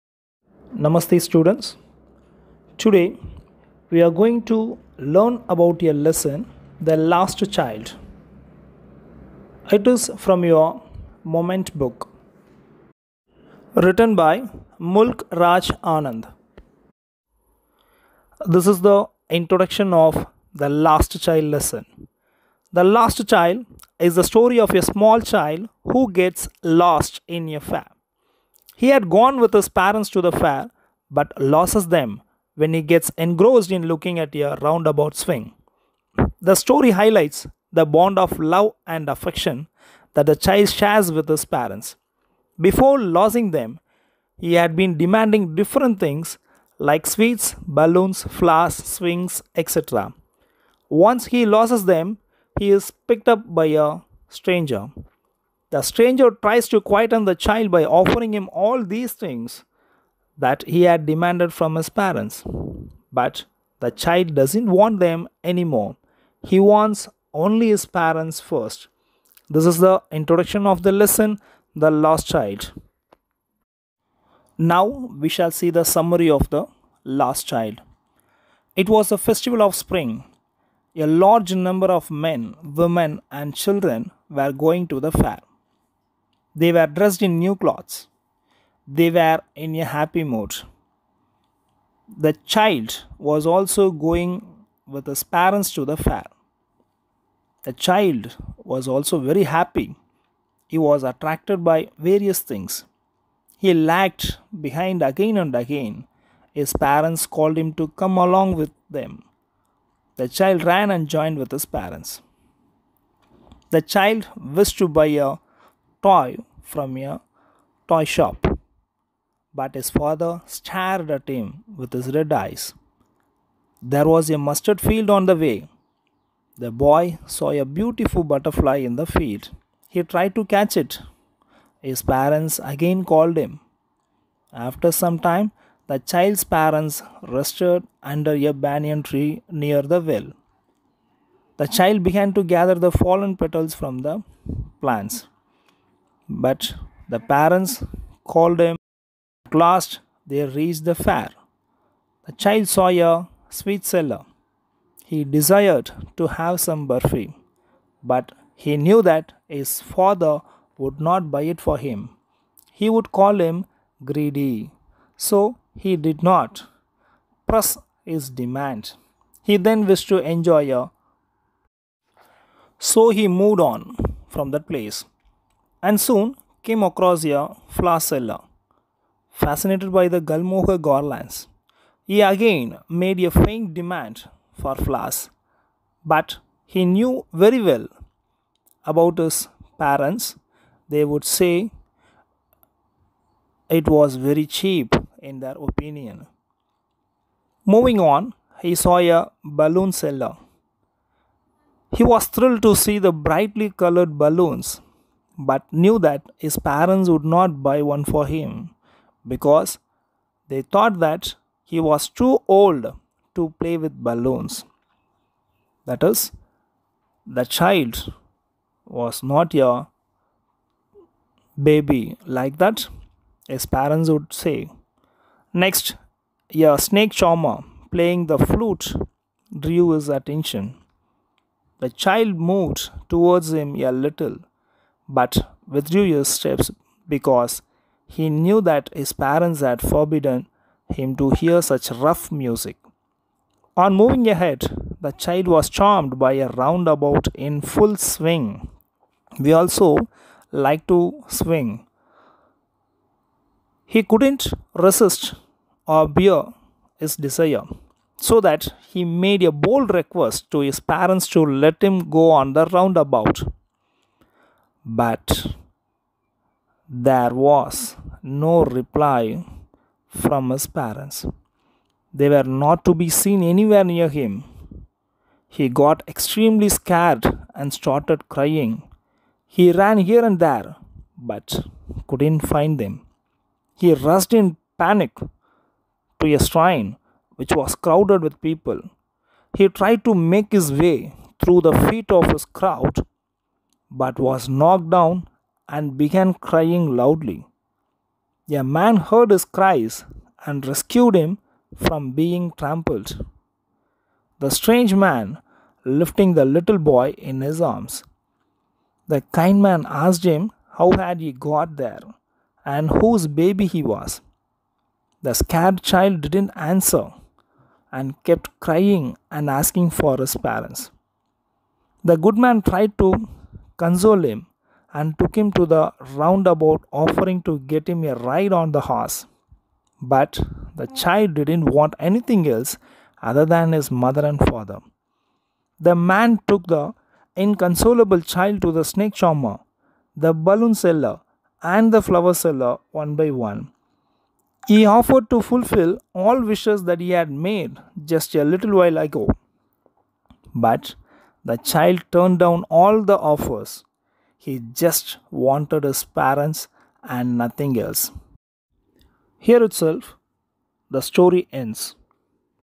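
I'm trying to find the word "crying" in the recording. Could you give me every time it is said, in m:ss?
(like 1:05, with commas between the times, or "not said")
4:38, 4:56, 5:18.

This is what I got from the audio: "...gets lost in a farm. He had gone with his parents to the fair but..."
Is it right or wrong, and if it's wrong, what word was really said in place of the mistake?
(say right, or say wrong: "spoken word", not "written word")
right.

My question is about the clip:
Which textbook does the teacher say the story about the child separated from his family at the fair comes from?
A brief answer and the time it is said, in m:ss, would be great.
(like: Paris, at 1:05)
Moment, at 0:11.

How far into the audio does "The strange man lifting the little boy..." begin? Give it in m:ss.
5:04.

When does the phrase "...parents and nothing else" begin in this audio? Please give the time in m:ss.
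5:56.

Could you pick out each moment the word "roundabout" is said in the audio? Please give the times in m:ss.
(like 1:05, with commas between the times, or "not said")
0:34, 4:06, 4:22, 5:26.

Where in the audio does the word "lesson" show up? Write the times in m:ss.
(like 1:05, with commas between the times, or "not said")
0:06, 0:21, 1:10.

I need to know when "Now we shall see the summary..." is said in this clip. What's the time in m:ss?
1:14.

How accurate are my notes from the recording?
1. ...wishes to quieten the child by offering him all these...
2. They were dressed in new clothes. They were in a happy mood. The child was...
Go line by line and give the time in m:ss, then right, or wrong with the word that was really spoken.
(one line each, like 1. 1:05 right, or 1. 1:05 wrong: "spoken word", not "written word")
1. 0:56 wrong: "tries", not "wishes"
2. 1:26 right.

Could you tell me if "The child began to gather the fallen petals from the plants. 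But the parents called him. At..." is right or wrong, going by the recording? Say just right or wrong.
right.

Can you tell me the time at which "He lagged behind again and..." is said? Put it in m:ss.
1:43.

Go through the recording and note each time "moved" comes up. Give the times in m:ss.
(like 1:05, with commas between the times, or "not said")
2:53, 3:52.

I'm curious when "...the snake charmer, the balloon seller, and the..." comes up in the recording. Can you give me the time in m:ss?
5:38.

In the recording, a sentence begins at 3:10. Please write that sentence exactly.
They would say it was very cheap in their opinion.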